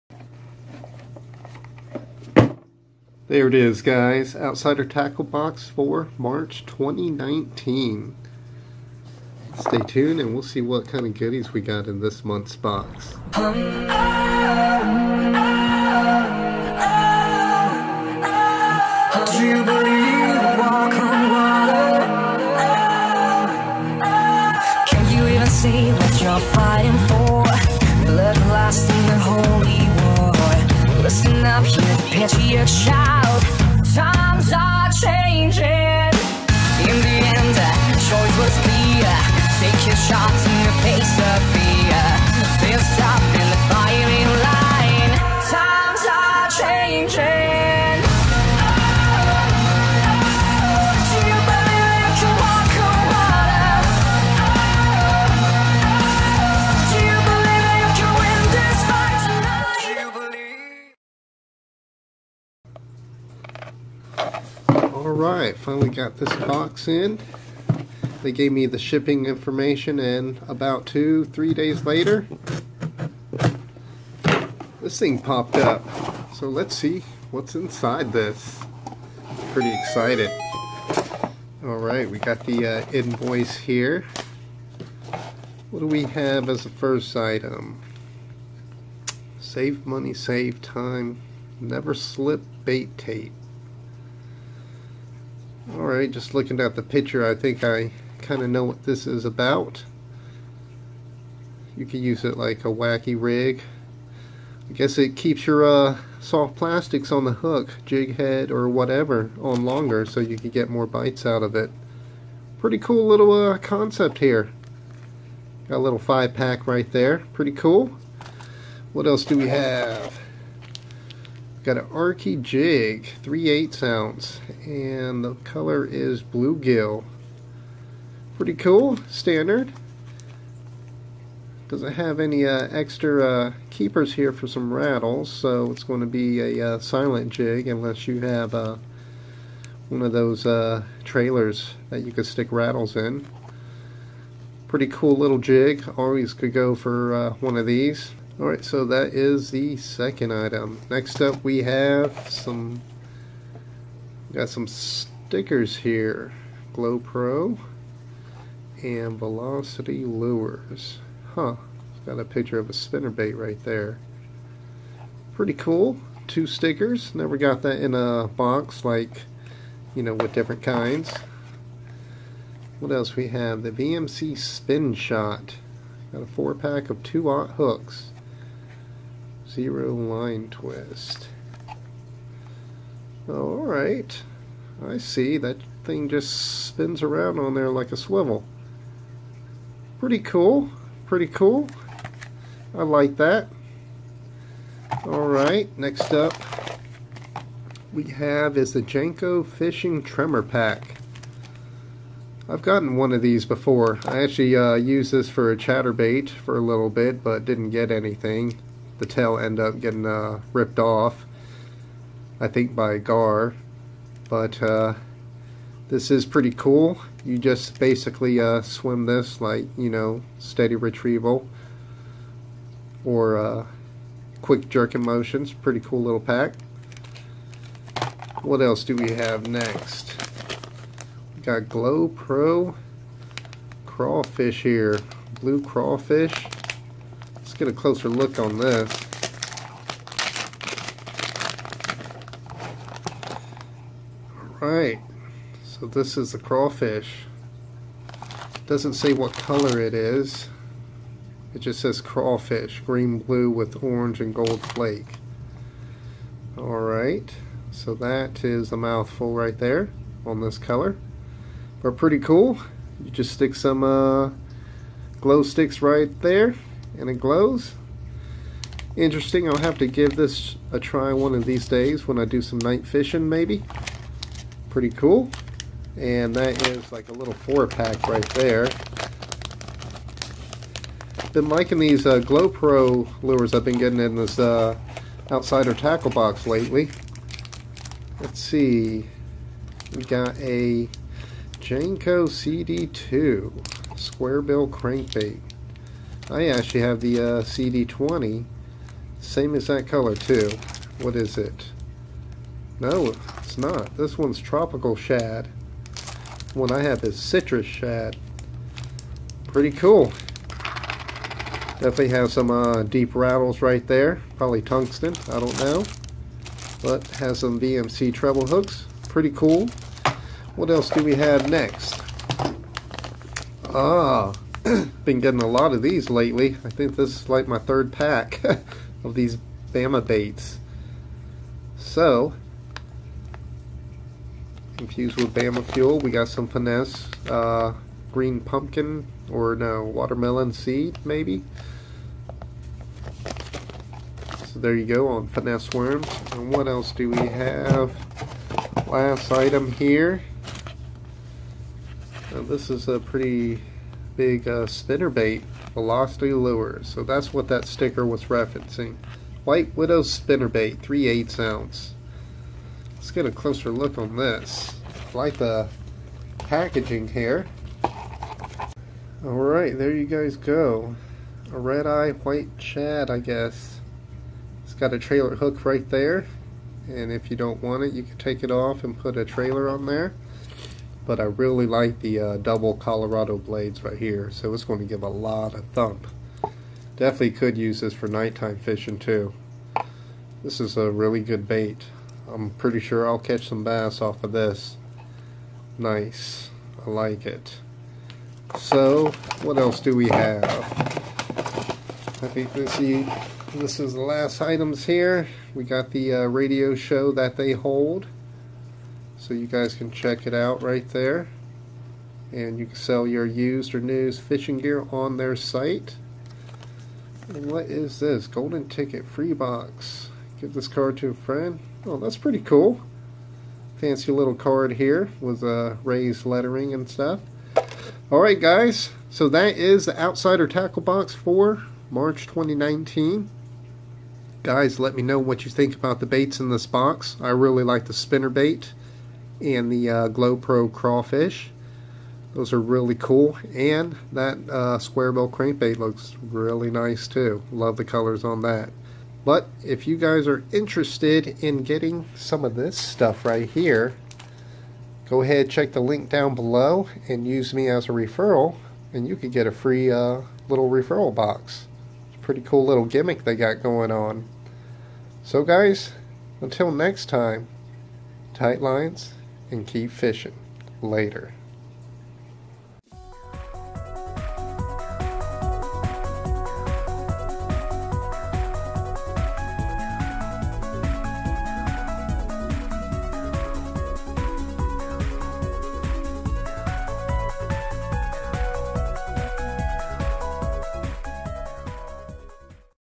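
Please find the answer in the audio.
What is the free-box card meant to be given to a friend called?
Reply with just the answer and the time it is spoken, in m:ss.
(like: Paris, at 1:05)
Golden ticket, at 6:58.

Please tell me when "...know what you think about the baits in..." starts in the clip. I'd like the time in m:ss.
7:15.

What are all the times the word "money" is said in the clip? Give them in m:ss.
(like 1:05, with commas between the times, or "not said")
1:29.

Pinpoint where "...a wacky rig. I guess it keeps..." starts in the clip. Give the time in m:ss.
1:42.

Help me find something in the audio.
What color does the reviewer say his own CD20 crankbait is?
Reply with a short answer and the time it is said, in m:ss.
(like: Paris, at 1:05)
Citrus shad, at 5:07.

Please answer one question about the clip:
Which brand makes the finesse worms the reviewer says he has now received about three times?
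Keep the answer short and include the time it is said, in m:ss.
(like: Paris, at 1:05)
Bama baits, at 5:29.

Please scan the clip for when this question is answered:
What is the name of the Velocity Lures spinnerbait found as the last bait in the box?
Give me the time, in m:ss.
5:59.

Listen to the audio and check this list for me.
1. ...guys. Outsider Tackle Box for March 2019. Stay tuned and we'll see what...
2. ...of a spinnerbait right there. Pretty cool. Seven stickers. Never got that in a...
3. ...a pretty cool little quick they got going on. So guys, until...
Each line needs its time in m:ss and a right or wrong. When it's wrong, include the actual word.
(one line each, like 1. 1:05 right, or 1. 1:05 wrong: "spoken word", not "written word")
1. 0:03 right
2. 2:42 wrong: "Two", not "Seven"
3. 7:42 wrong: "gimmick", not "quick".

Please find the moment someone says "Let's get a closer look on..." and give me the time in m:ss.
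6:02.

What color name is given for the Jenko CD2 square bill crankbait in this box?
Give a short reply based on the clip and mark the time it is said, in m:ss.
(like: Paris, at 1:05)
Tropical shad, at 5:04.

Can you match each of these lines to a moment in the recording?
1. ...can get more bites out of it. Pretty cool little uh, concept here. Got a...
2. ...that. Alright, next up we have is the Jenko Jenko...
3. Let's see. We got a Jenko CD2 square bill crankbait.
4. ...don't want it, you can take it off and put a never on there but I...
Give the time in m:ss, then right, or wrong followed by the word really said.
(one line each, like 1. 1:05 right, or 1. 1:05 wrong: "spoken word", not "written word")
1. 1:50 right
2. 3:13 wrong: "Fishing", not "Jenko"
3. 4:48 right
4. 6:17 wrong: "trailer", not "never".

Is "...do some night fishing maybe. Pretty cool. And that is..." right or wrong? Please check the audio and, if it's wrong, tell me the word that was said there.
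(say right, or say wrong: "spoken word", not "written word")
right.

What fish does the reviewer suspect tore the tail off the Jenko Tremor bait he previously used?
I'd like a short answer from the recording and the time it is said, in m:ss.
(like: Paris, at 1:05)
Gar, at 3:32.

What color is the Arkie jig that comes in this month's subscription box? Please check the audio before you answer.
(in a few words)
Bluegill.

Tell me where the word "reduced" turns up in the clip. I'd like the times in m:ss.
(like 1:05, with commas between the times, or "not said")
not said.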